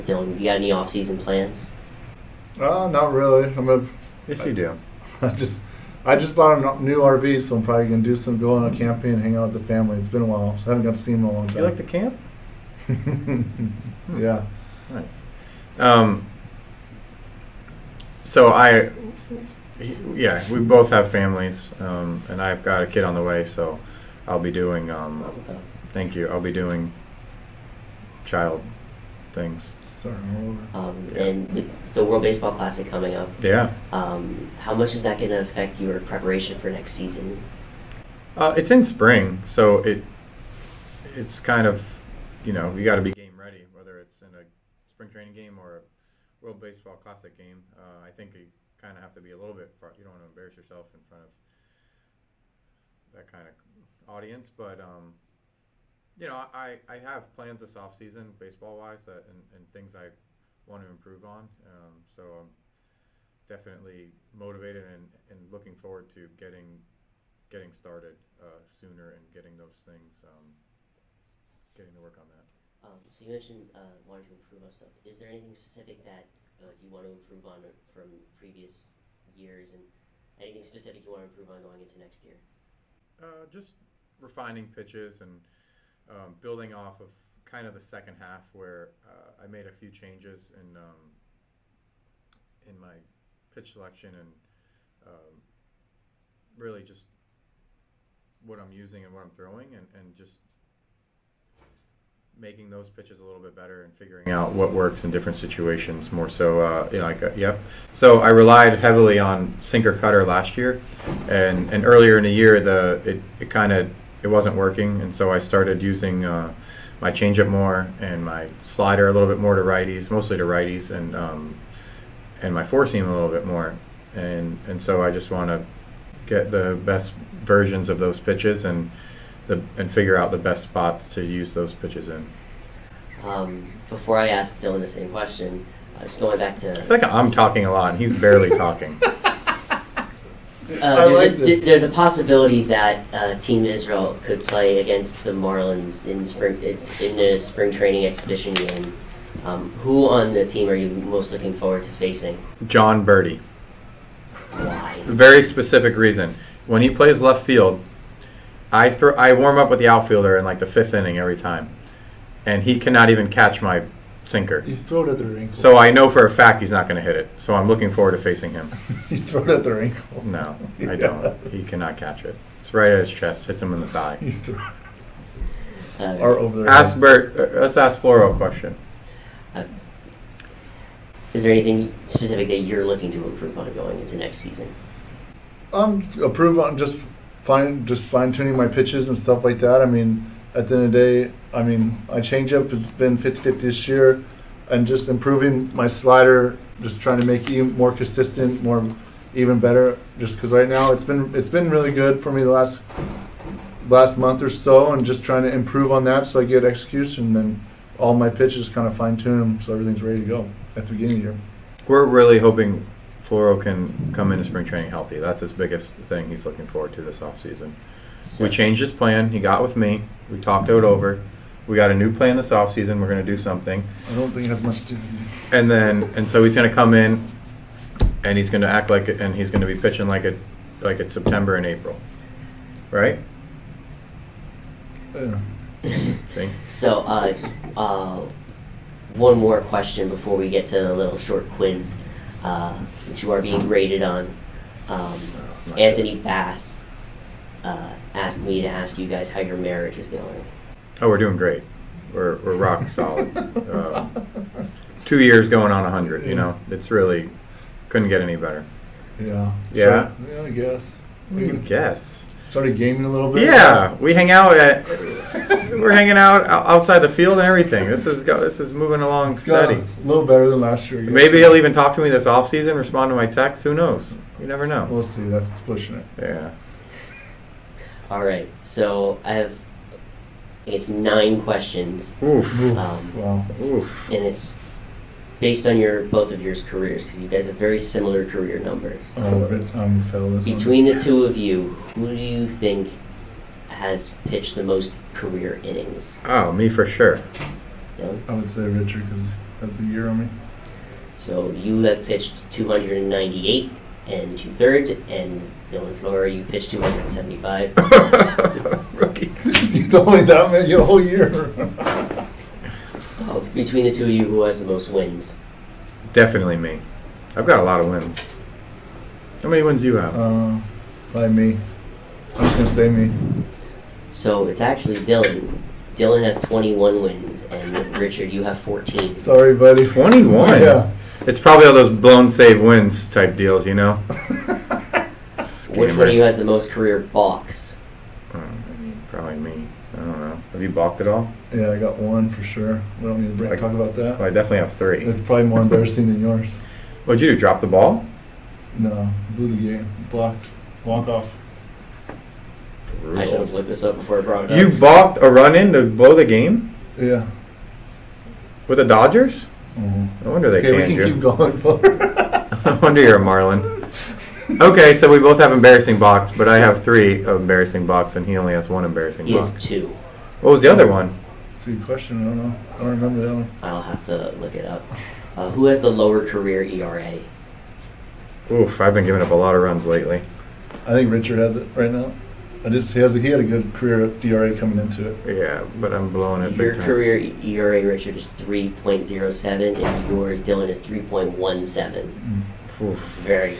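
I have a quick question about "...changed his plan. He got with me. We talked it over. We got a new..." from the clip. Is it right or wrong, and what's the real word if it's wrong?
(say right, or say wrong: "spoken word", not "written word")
right.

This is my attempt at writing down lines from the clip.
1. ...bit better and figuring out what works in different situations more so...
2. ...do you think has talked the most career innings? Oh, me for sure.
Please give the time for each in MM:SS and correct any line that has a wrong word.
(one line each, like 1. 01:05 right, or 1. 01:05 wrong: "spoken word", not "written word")
1. 01:43 right
2. 04:52 wrong: "pitched", not "talked".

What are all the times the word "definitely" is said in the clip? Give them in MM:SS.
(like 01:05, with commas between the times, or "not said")
01:03, 05:16, 05:44.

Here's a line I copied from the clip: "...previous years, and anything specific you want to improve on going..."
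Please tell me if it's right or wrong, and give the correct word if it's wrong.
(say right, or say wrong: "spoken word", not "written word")
right.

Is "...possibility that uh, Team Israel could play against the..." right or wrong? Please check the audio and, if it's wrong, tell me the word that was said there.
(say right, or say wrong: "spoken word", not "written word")
right.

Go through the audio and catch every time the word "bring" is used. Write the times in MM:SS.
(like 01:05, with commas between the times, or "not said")
05:43.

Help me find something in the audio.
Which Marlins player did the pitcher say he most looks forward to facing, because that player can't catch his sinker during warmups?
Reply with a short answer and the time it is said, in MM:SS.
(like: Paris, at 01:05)
Jon Berti, at 02:32.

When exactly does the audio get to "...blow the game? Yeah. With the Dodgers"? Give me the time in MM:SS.
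05:55.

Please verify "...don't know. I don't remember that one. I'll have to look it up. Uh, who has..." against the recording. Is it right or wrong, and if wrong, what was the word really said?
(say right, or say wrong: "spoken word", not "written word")
right.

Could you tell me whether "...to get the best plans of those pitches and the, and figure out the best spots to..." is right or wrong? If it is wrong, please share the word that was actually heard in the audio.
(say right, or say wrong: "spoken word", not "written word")
wrong: "versions", not "plans".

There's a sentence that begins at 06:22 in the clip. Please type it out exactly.
I just he has a, he had a good career at coming into it.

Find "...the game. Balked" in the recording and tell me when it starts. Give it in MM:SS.
05:49.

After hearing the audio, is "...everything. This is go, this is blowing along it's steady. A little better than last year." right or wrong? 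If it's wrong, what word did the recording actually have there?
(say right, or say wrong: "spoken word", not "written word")
wrong: "moving", not "blowing".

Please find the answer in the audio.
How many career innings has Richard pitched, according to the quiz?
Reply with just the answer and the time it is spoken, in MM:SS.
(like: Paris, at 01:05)
298 2/3, at 05:02.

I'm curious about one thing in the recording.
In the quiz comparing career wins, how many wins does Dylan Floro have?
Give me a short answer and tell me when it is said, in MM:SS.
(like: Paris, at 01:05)
21, at 05:26.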